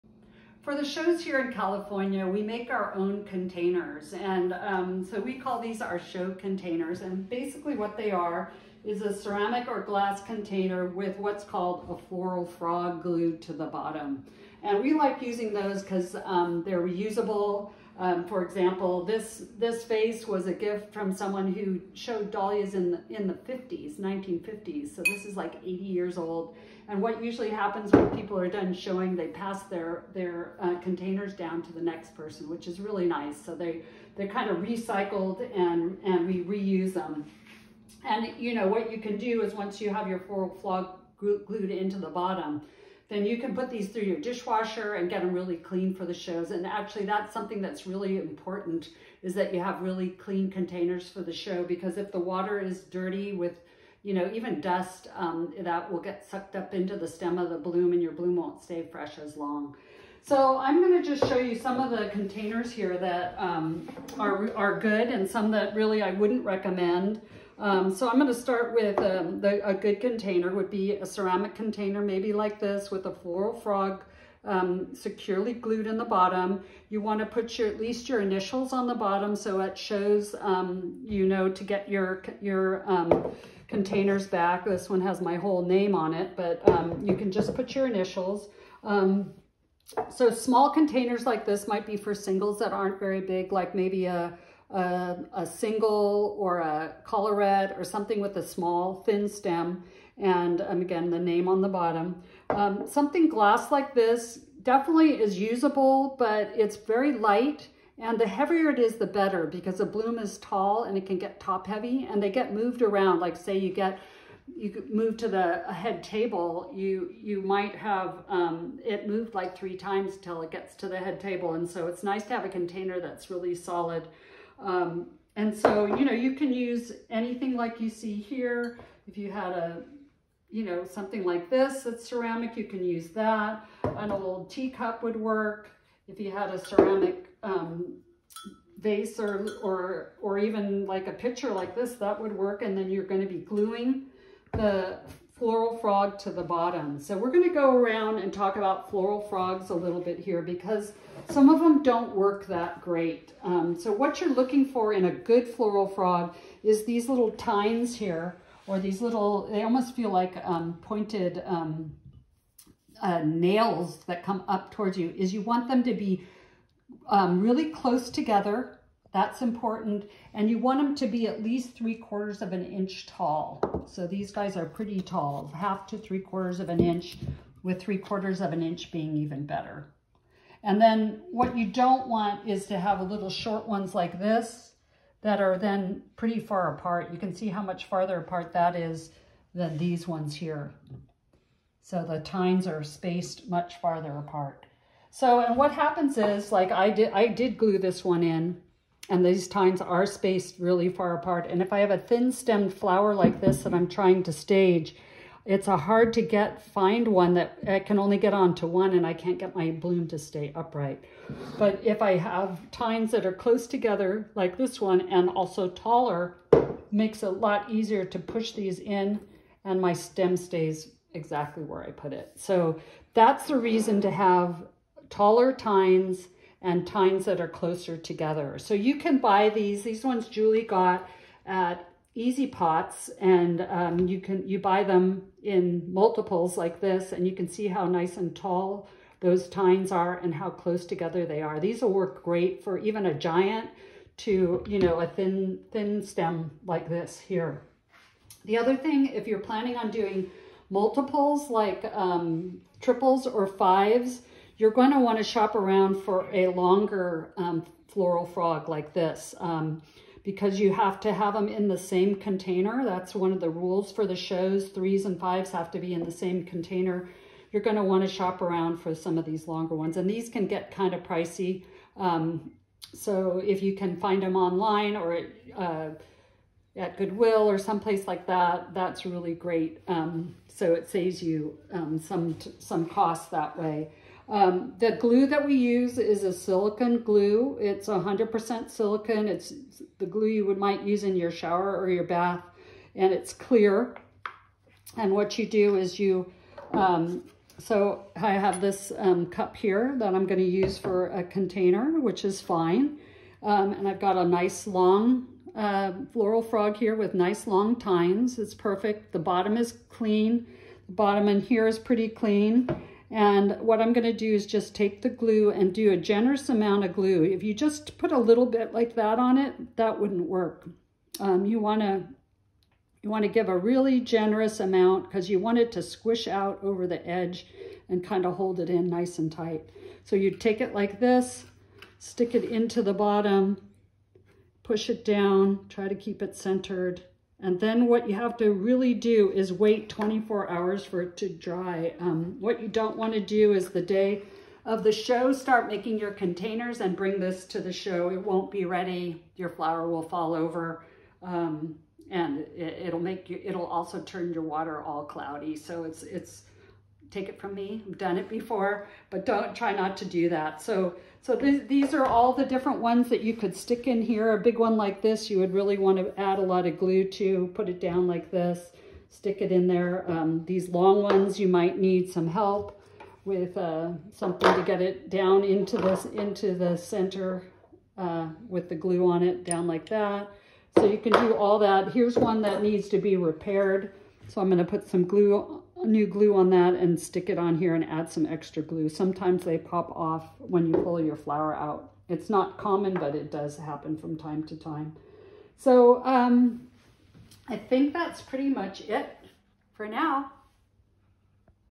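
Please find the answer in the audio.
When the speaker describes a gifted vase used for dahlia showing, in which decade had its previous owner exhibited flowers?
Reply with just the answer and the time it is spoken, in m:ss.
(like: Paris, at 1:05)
1950s, at 0:23.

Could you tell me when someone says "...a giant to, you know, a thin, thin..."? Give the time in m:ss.
4:03.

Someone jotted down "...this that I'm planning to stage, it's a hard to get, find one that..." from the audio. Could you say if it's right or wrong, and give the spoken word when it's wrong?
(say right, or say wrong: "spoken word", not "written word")
wrong: "trying", not "planning".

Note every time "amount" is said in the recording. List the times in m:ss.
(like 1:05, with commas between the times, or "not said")
5:16, 5:24.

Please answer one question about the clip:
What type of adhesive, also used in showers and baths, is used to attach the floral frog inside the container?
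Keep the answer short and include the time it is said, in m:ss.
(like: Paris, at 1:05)
Silicone glue, at 4:46.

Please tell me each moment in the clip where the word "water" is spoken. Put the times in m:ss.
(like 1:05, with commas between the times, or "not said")
0:52, 5:54.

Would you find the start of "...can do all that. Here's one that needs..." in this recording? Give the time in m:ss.
6:20.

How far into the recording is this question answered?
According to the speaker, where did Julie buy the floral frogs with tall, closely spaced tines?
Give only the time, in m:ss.
3:52.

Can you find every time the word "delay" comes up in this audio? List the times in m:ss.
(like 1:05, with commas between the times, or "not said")
not said.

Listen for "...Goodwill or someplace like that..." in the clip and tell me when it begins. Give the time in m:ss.
4:36.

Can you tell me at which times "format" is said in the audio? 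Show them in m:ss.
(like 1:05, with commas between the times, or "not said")
not said.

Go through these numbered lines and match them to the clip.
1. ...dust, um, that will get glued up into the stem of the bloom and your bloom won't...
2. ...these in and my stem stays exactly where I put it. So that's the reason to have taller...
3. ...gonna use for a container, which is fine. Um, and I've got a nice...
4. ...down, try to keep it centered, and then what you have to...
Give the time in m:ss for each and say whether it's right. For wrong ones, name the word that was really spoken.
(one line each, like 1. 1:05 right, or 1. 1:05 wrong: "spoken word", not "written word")
1. 0:54 wrong: "sucked", not "glued"
2. 3:38 right
3. 5:00 right
4. 5:35 right.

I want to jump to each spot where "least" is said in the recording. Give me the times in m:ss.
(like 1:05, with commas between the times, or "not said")
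1:17, 2:51.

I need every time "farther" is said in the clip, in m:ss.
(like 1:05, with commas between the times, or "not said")
3:07, 3:13.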